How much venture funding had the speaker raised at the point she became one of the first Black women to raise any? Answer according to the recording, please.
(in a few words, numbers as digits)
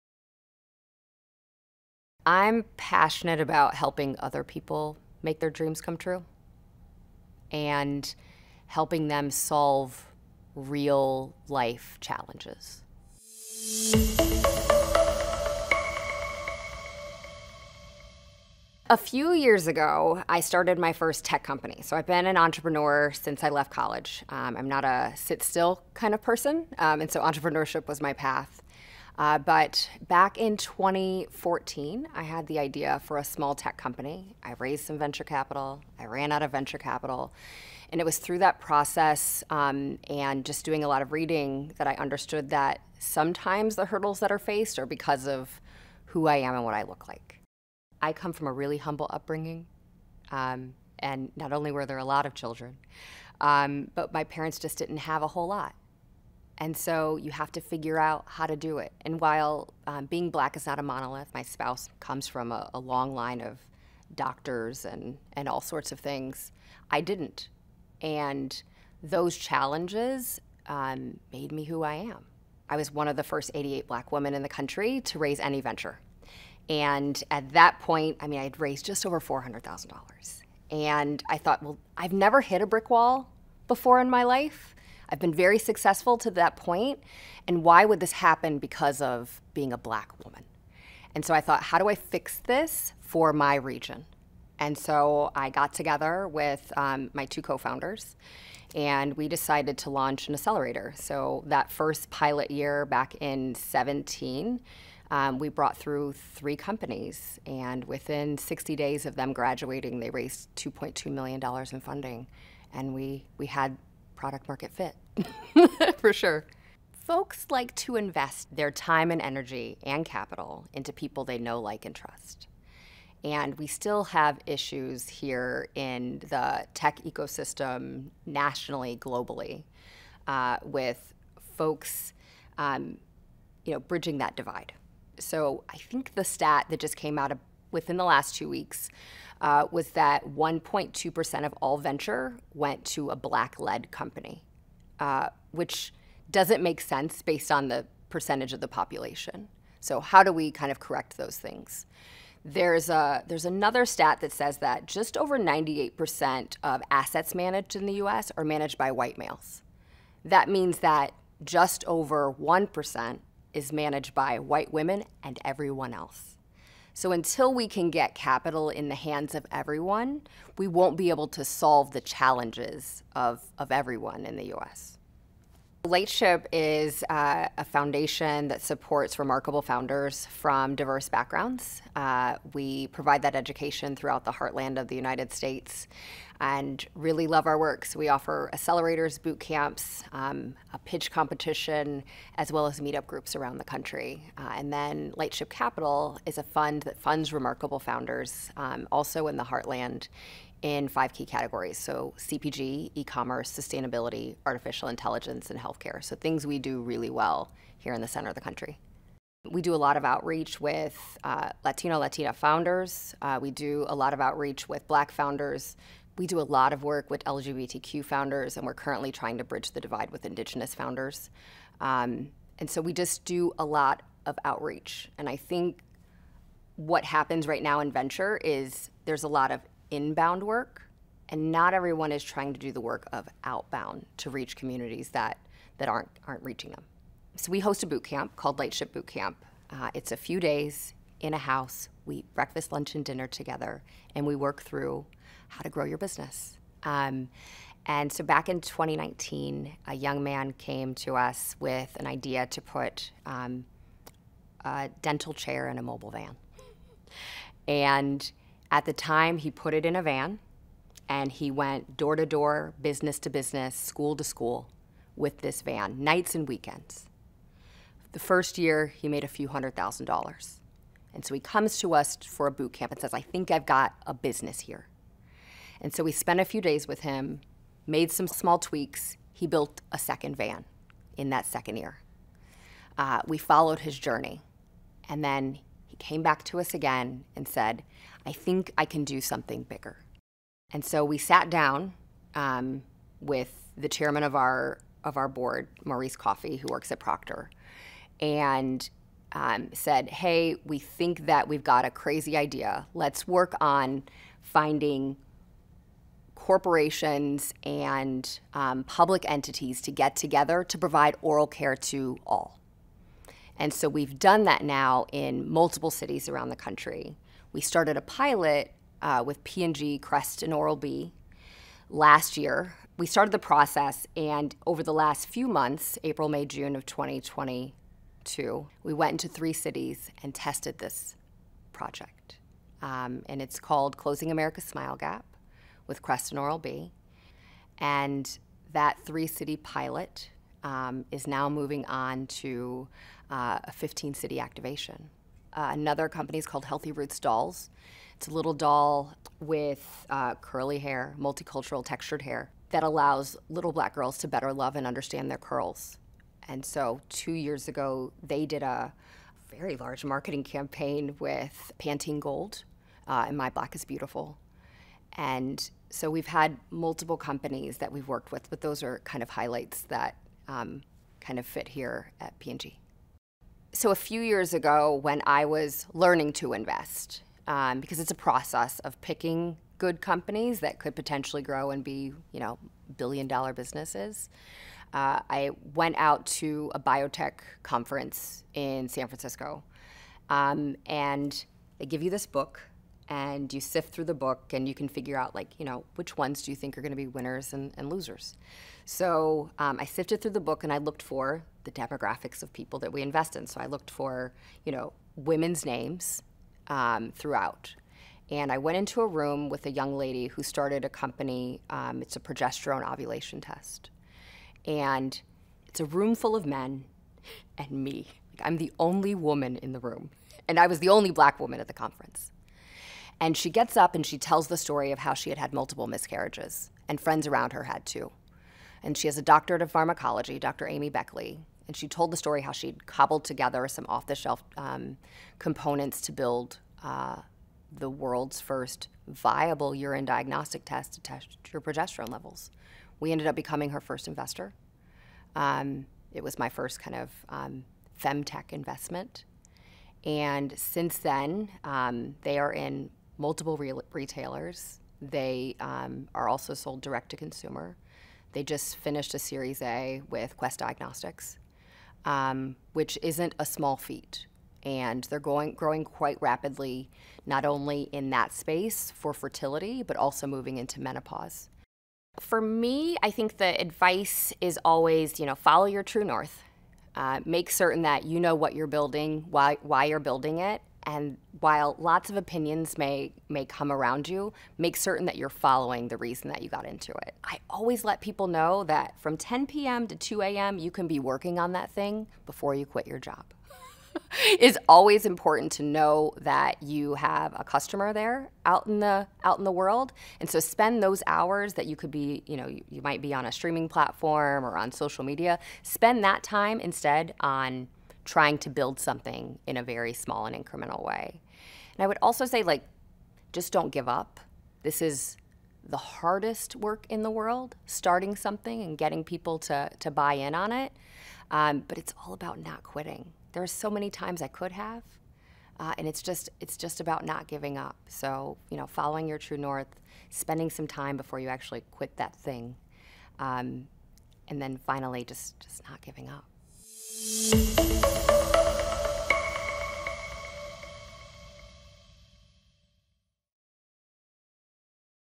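just over $400,000.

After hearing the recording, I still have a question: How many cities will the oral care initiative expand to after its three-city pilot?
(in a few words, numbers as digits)
15.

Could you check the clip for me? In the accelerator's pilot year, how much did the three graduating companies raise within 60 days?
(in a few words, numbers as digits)
$2.2 million.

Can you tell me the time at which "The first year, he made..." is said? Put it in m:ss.
4:28.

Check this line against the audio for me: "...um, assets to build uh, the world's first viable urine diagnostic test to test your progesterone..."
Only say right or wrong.
wrong.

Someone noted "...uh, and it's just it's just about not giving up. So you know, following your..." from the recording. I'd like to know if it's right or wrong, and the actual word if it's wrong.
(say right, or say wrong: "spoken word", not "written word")
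right.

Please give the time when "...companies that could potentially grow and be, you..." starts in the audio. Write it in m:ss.
6:20.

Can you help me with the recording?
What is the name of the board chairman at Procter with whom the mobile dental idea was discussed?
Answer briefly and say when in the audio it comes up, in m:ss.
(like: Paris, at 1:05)
Maurice Coffey, at 4:55.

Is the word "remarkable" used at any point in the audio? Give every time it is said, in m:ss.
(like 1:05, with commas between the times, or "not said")
2:59, 3:17.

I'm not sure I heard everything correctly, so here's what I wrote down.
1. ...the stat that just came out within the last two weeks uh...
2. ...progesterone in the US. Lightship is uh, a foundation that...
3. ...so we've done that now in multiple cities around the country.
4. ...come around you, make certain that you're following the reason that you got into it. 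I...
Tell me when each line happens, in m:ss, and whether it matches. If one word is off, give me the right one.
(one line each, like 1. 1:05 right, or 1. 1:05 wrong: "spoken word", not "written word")
1. 2:16 right
2. 2:53 wrong: "everyone", not "progesterone"
3. 5:13 right
4. 8:03 right.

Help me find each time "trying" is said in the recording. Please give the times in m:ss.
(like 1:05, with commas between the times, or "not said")
3:39, 3:52, 8:28.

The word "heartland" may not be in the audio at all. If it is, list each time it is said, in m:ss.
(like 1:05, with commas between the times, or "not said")
3:04, 3:19.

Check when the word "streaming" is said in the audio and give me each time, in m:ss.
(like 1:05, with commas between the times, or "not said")
8:23.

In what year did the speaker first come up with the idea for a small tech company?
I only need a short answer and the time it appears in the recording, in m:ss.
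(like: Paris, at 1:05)
2014, at 0:30.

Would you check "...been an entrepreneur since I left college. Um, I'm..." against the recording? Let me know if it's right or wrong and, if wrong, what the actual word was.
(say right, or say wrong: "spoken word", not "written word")
right.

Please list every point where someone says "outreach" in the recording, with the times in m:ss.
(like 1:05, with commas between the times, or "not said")
3:30, 3:34, 3:44.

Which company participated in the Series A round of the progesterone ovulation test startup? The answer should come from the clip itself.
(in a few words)
Quest Diagnostics.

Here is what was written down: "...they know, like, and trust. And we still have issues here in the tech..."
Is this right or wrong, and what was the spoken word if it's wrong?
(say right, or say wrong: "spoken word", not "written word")
right.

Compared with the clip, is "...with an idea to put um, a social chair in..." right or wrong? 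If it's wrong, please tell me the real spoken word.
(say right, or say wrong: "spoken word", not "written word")
wrong: "dental", not "social".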